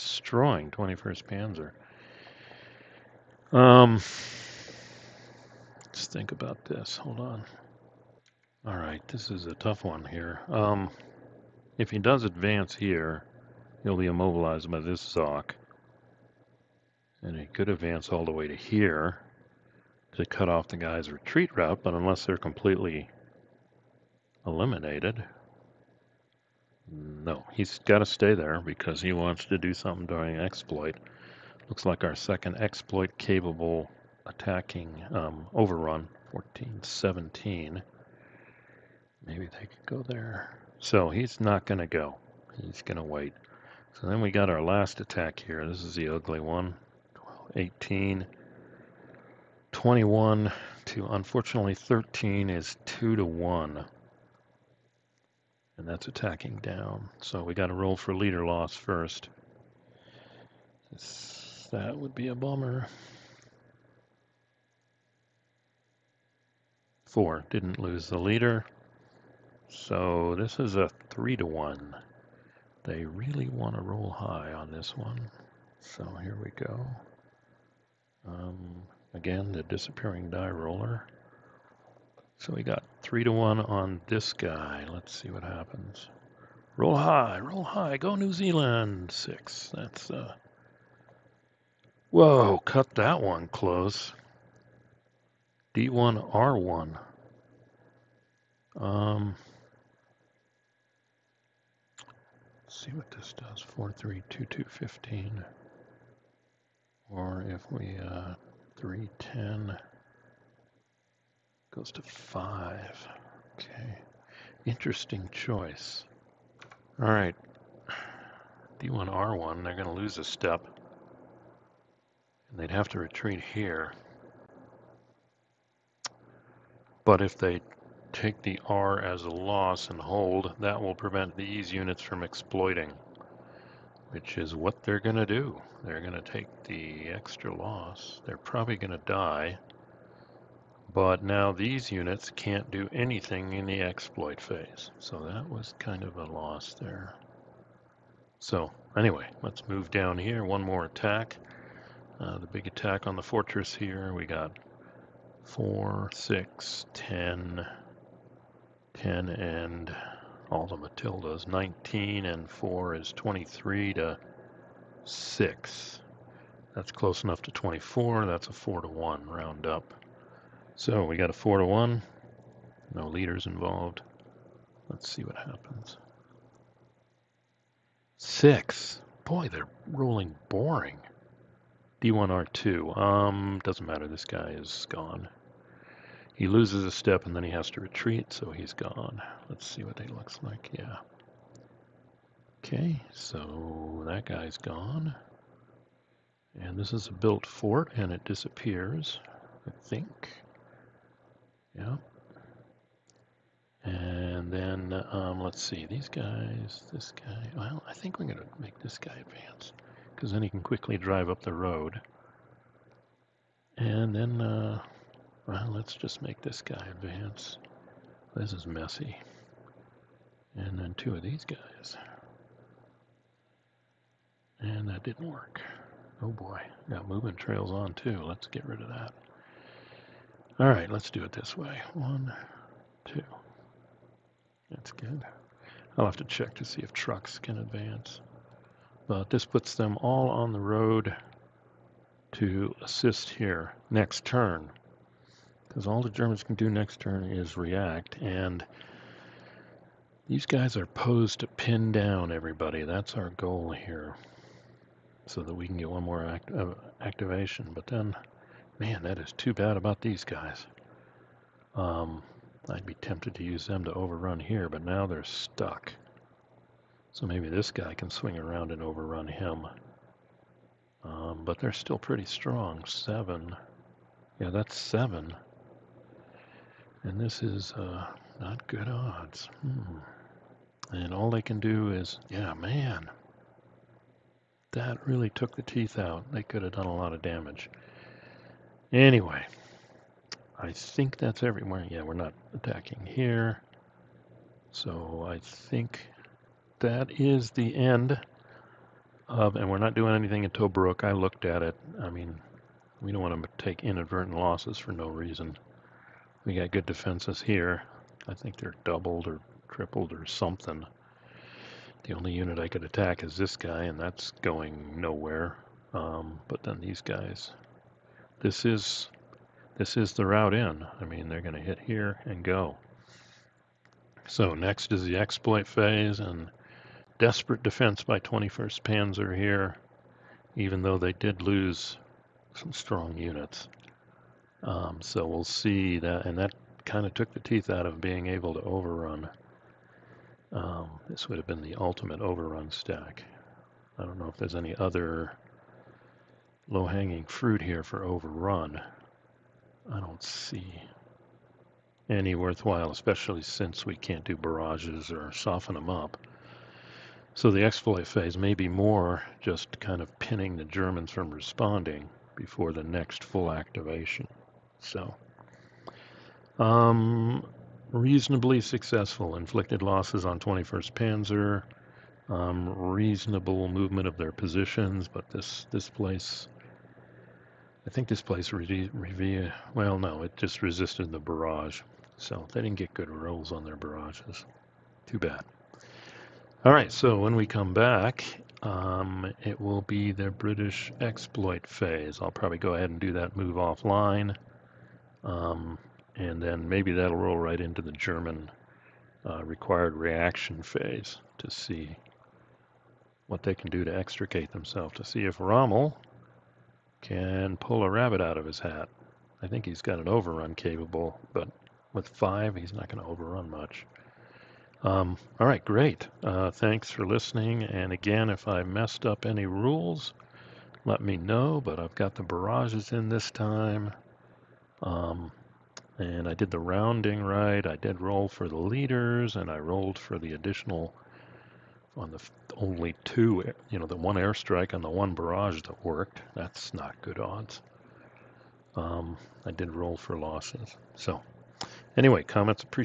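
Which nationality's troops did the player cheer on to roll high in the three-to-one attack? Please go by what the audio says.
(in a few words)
New Zealand.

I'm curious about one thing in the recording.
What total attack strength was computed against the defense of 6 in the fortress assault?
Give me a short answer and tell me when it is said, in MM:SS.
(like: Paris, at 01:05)
23, at 02:43.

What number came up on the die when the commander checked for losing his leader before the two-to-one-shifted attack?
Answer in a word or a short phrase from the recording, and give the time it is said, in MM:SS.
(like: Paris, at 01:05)
4, at 01:07.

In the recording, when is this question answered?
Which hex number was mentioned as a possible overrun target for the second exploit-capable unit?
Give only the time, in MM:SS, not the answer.
00:36.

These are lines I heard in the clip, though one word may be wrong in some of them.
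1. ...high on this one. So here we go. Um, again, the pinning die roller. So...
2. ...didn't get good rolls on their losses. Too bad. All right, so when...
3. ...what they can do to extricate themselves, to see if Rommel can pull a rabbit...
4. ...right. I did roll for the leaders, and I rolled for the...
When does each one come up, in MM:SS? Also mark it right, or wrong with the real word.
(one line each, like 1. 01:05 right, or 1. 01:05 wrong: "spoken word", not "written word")
1. 01:14 wrong: "disappearing", not "pinning"
2. 06:22 wrong: "barrages", not "losses"
3. 06:43 right
4. 07:07 right.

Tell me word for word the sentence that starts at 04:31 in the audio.
Um, but they're still pretty strong.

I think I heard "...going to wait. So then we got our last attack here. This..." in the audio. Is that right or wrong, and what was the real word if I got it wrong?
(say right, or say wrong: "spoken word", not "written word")
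right.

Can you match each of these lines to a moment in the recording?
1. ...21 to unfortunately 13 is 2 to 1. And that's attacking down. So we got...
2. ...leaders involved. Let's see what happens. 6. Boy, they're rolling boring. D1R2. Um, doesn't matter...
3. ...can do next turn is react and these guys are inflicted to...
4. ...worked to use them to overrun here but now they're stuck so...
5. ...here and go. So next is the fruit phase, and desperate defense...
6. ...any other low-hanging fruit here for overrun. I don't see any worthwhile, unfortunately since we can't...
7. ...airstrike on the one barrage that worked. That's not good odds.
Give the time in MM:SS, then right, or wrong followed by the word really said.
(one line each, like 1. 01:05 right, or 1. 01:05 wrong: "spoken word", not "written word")
1. 00:49 right
2. 02:53 right
3. 04:06 wrong: "posed", not "inflicted"
4. 04:22 wrong: "tempted", not "worked"
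5. 05:21 wrong: "exploit", not "fruit"
6. 05:44 wrong: "especially", not "unfortunately"
7. 07:14 right.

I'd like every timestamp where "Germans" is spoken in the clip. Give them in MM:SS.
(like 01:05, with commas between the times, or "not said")
04:06, 06:00, 06:37.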